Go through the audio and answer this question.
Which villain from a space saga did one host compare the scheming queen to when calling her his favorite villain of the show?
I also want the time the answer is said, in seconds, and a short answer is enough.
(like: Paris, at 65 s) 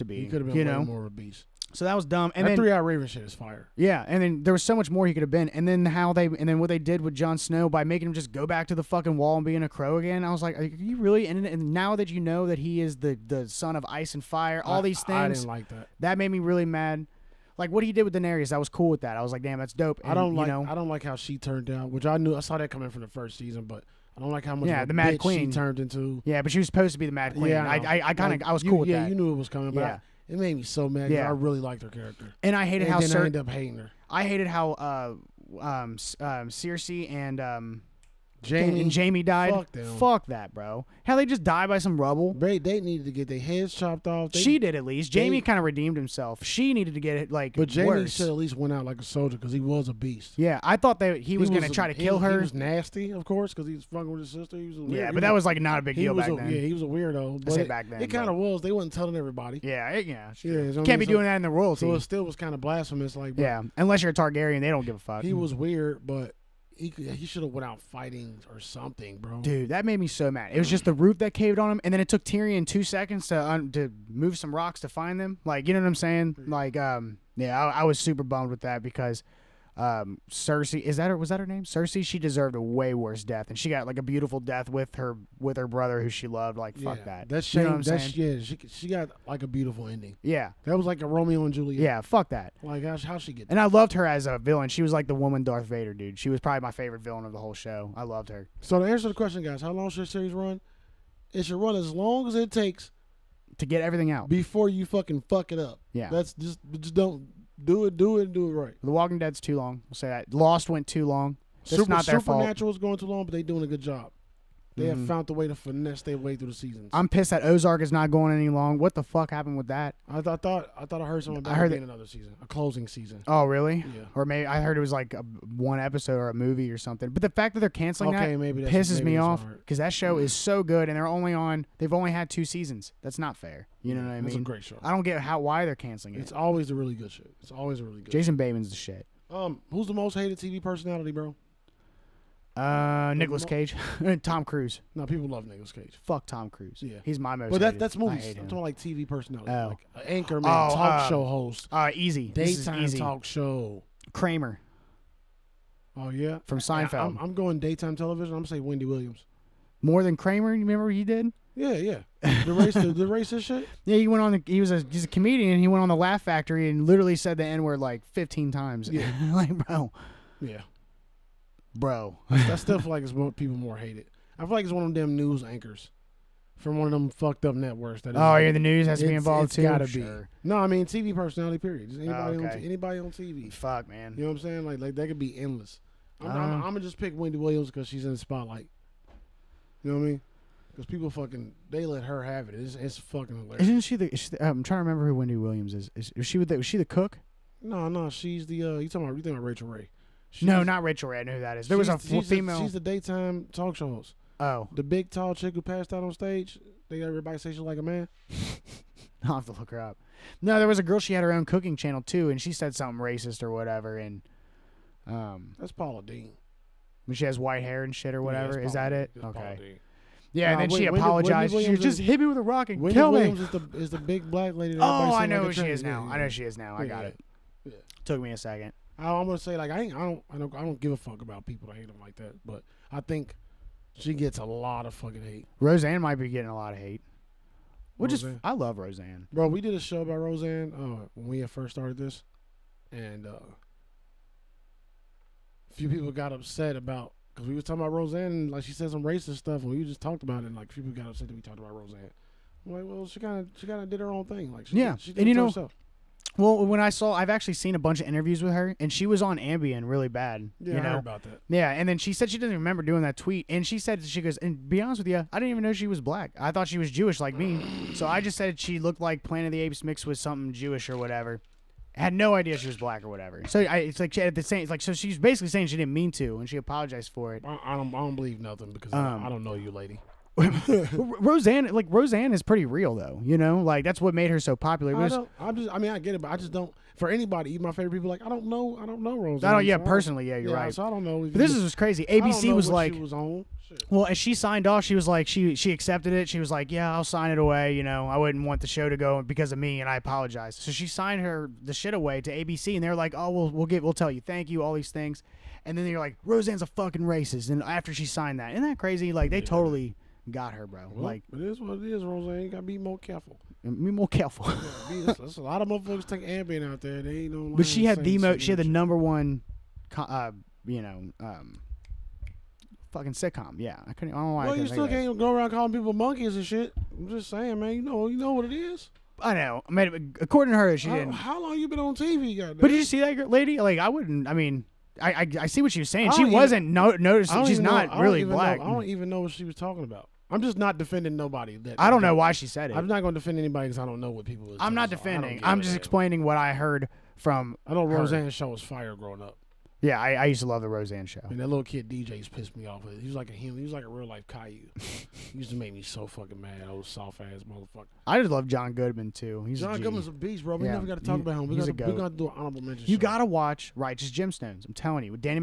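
Darth Vader, at 95 s.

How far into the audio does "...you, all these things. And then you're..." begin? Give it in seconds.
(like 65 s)
304 s.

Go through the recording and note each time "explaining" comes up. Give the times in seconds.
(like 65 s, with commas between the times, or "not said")
345 s.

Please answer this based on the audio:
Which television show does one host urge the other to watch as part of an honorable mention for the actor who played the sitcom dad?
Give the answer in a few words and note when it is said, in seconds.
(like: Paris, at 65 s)
Righteous Gemstones, at 363 s.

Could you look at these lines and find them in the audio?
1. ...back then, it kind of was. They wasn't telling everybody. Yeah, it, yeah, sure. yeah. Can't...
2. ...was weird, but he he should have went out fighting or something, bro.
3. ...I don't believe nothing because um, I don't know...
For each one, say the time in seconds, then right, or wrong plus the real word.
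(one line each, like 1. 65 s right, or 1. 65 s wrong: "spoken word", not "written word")
1. 57 s right
2. 65 s right
3. 277 s right.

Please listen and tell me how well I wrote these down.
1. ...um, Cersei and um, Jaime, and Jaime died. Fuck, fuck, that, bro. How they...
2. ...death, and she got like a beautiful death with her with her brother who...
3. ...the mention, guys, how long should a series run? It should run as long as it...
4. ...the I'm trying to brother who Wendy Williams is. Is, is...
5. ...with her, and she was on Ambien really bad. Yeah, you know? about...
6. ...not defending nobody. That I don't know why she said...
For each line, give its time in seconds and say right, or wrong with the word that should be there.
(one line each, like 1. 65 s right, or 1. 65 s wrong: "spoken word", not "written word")
1. 36 s right
2. 83 s right
3. 99 s wrong: "question", not "mention"
4. 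194 s wrong: "remember", not "brother"
5. 258 s right
6. 340 s right.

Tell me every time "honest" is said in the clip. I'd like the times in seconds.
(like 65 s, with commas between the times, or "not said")
264 s.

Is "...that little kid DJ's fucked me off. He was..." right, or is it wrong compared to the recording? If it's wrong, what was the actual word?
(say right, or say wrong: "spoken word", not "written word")
wrong: "pissed", not "fucked".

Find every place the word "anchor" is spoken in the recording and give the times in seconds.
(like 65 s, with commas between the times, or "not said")
150 s, 175 s.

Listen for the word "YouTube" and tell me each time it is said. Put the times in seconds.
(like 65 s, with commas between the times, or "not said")
not said.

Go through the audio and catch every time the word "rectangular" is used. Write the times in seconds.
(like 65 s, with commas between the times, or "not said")
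not said.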